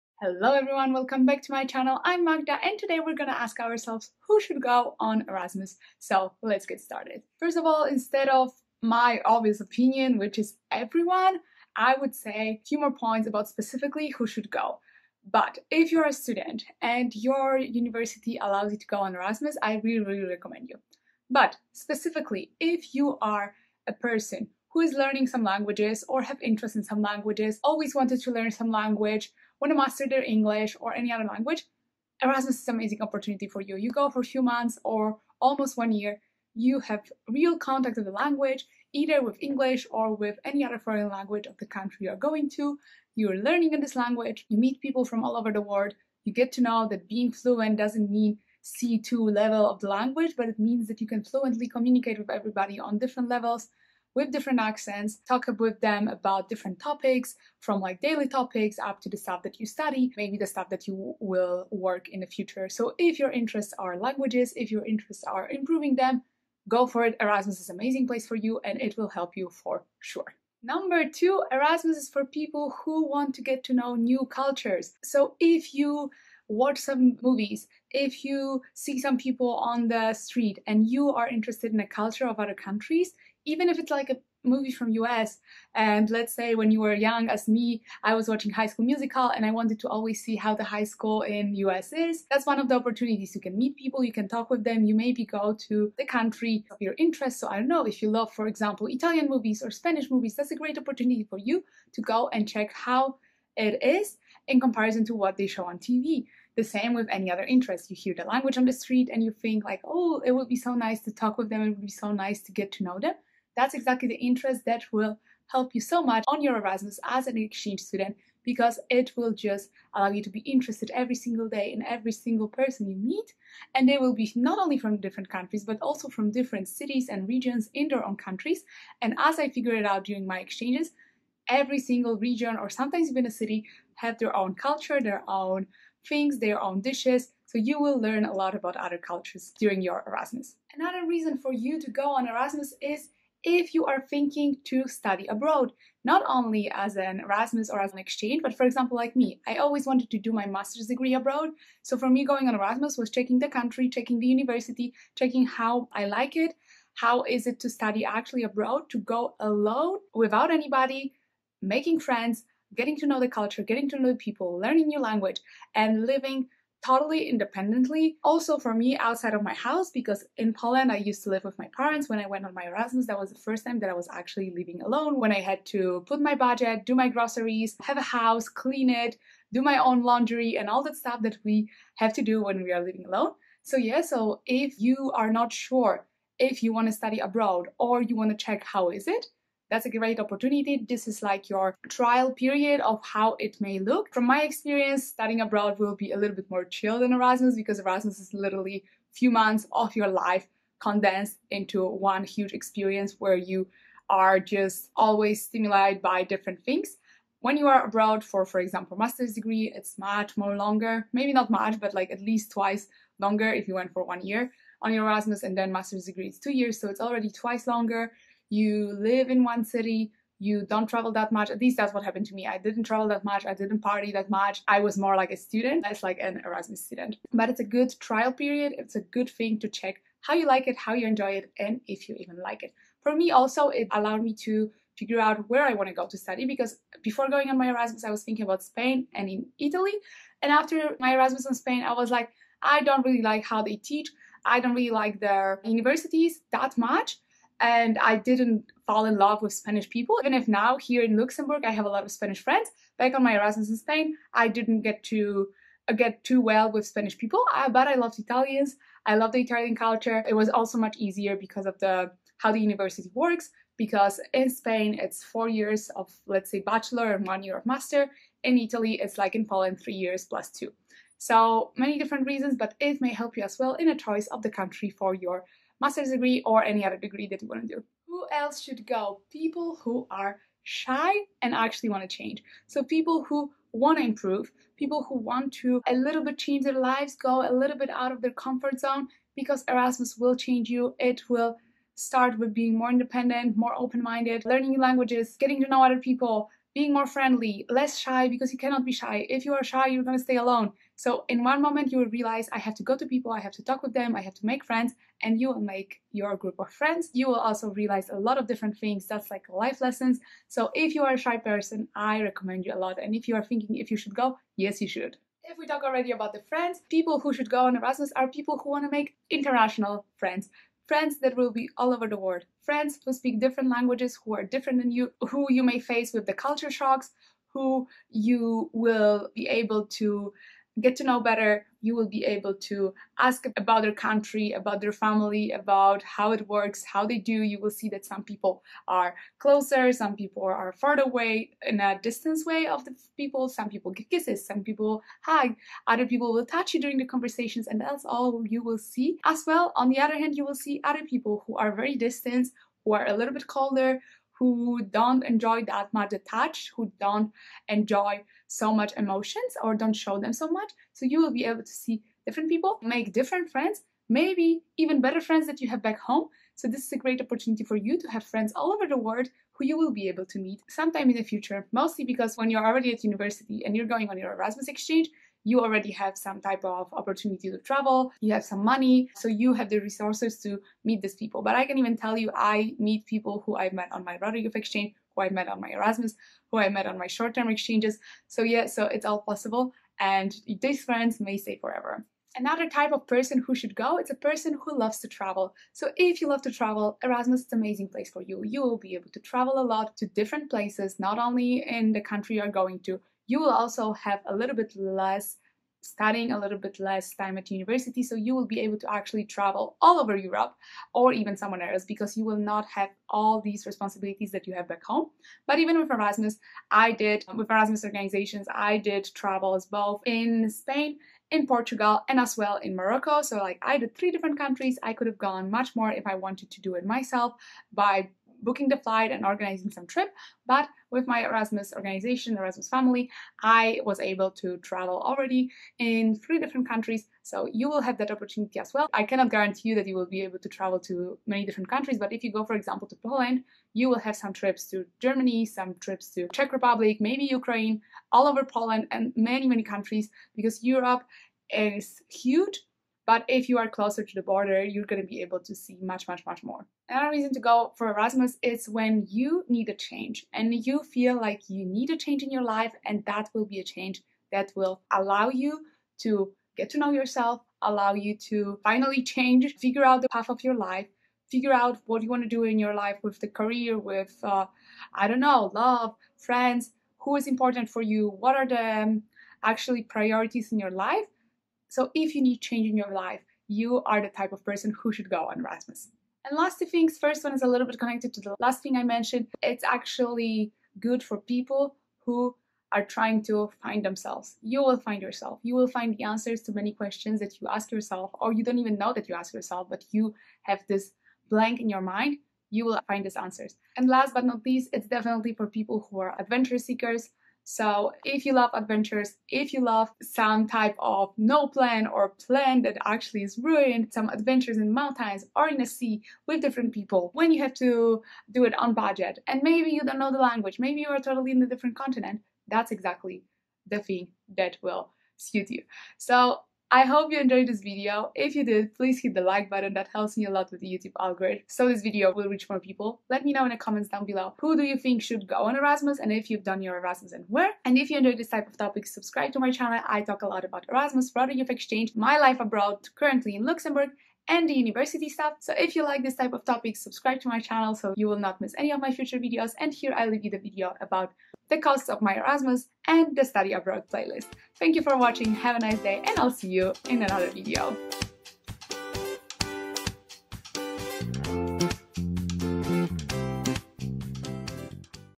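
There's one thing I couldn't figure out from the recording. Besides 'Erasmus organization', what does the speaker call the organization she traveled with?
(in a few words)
Erasmus family.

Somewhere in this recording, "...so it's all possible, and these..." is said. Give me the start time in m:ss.
6:28.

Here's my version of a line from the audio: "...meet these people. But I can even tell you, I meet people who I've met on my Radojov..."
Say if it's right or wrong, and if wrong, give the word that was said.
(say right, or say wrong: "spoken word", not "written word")
right.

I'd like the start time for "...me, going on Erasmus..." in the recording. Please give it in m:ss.
2:32.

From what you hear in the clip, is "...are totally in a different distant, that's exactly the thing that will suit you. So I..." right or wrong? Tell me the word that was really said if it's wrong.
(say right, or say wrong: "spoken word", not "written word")
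wrong: "continent", not "distant".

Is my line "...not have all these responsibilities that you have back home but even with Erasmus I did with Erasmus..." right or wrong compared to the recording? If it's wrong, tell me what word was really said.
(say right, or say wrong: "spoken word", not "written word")
right.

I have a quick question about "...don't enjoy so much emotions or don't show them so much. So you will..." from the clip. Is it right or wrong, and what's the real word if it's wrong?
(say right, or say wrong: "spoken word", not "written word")
right.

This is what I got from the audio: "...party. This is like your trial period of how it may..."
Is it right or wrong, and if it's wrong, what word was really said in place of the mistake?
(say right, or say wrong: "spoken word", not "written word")
wrong: "opportunity", not "party".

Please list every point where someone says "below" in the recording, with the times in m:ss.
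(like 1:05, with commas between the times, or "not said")
8:54.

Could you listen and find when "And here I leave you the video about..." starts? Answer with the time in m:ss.
9:09.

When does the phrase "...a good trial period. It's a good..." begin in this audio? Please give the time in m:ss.
3:47.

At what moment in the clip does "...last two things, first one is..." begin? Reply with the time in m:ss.
8:06.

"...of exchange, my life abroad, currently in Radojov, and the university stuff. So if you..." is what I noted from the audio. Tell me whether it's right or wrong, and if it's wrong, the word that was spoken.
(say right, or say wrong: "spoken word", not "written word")
wrong: "Luxembourg", not "Radojov".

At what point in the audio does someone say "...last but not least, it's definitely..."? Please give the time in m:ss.
8:23.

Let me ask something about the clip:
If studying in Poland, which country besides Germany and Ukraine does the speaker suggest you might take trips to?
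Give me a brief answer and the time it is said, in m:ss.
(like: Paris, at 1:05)
Czech Republic, at 7:26.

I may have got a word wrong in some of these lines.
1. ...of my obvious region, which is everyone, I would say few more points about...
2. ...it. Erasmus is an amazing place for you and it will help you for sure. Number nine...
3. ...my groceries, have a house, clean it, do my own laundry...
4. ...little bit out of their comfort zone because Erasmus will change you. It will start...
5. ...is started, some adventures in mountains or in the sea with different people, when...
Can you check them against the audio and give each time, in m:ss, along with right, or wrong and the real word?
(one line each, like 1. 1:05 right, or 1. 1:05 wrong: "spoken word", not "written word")
1. 0:08 wrong: "opinion", not "region"
2. 1:07 wrong: "two", not "nine"
3. 2:56 right
4. 4:47 right
5. 8:33 wrong: "ruined", not "started".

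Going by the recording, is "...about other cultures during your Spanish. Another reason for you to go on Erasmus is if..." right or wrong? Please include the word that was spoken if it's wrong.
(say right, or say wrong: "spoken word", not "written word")
wrong: "Erasmus", not "Spanish".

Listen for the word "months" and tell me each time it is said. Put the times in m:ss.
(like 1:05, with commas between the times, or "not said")
0:34, 3:19.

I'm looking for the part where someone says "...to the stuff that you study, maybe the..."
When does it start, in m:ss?
0:59.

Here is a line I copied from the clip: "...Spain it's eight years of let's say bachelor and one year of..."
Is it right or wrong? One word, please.
wrong.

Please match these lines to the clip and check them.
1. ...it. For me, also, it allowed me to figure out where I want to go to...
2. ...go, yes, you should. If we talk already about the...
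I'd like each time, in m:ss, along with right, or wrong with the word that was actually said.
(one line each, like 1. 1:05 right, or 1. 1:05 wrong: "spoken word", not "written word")
1. 3:52 right
2. 5:14 right.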